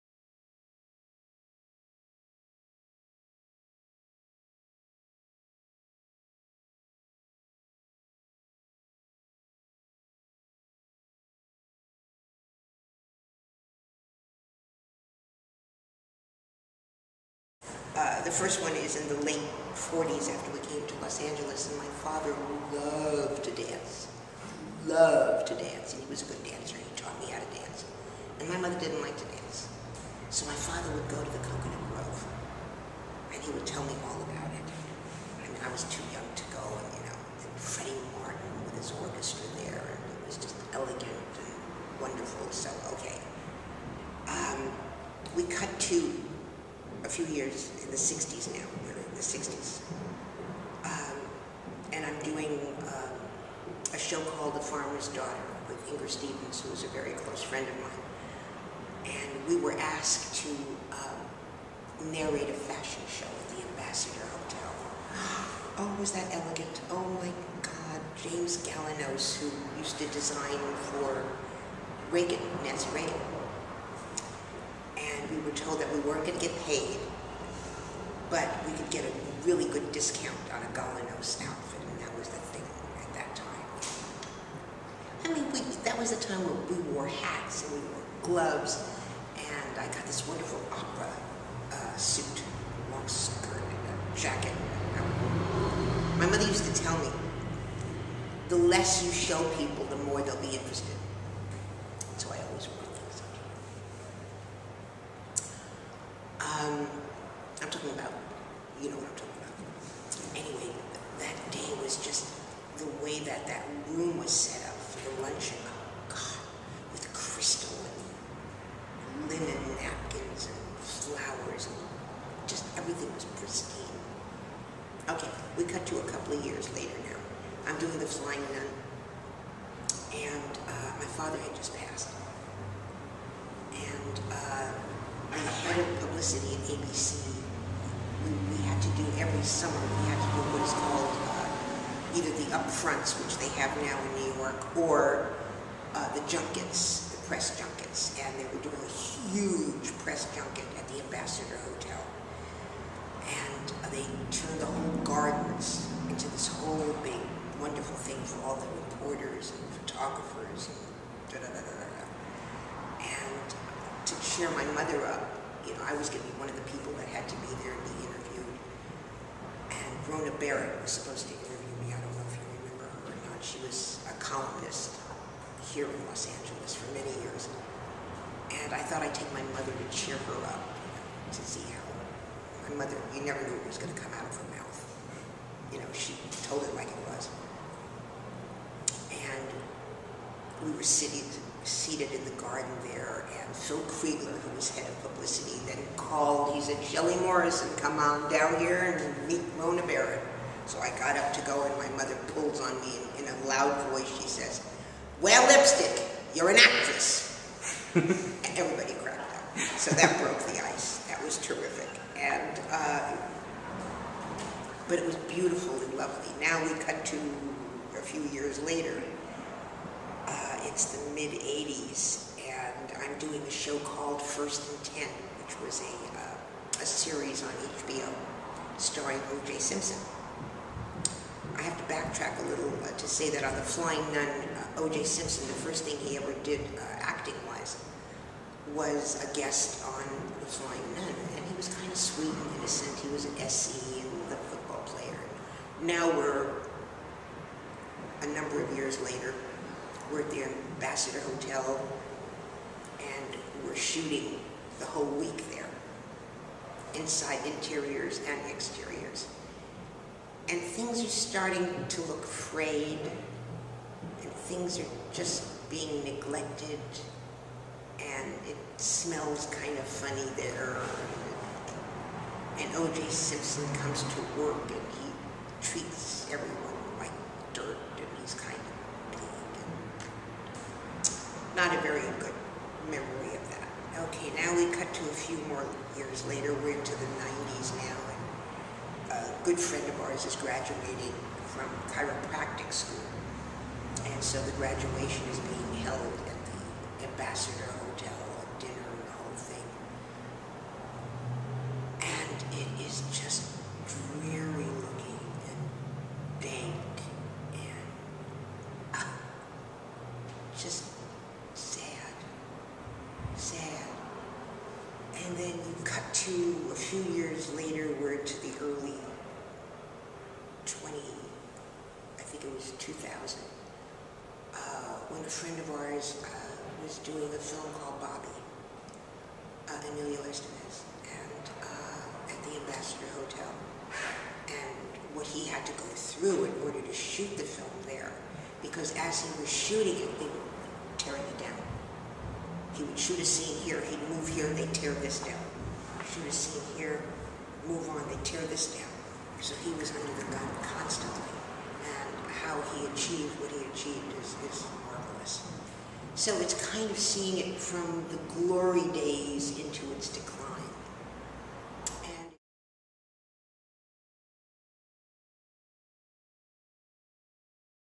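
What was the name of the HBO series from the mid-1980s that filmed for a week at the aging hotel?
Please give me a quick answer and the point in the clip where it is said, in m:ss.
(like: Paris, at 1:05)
First and Ten, at 3:44.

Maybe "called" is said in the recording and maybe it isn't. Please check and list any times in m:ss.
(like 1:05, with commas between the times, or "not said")
0:54, 2:20, 3:15, 3:43, 5:27.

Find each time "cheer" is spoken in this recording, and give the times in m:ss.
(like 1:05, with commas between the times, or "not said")
2:44, 2:59.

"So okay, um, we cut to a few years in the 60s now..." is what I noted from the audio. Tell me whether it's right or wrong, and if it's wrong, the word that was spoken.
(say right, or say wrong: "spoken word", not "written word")
right.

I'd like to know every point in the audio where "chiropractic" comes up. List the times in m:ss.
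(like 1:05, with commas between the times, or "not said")
4:51.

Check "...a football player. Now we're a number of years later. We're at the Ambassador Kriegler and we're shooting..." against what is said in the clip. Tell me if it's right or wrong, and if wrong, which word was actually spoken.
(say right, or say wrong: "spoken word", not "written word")
wrong: "Hotel", not "Kriegler".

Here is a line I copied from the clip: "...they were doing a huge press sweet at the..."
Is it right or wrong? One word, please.
wrong.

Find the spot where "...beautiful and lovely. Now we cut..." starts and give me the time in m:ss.
3:35.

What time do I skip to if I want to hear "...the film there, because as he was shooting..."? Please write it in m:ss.
5:37.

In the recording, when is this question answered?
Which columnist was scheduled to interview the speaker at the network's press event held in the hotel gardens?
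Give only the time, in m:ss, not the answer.
2:50.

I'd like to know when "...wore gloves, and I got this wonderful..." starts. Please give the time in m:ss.
1:27.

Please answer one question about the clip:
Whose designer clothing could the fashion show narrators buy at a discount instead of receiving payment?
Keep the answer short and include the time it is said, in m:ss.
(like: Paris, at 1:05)
James Galanos, at 1:08.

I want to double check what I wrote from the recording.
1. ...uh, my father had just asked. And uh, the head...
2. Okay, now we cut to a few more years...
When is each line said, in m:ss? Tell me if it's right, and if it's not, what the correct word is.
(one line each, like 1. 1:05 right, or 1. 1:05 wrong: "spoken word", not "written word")
1. 2:10 wrong: "passed", not "asked"
2. 4:44 right.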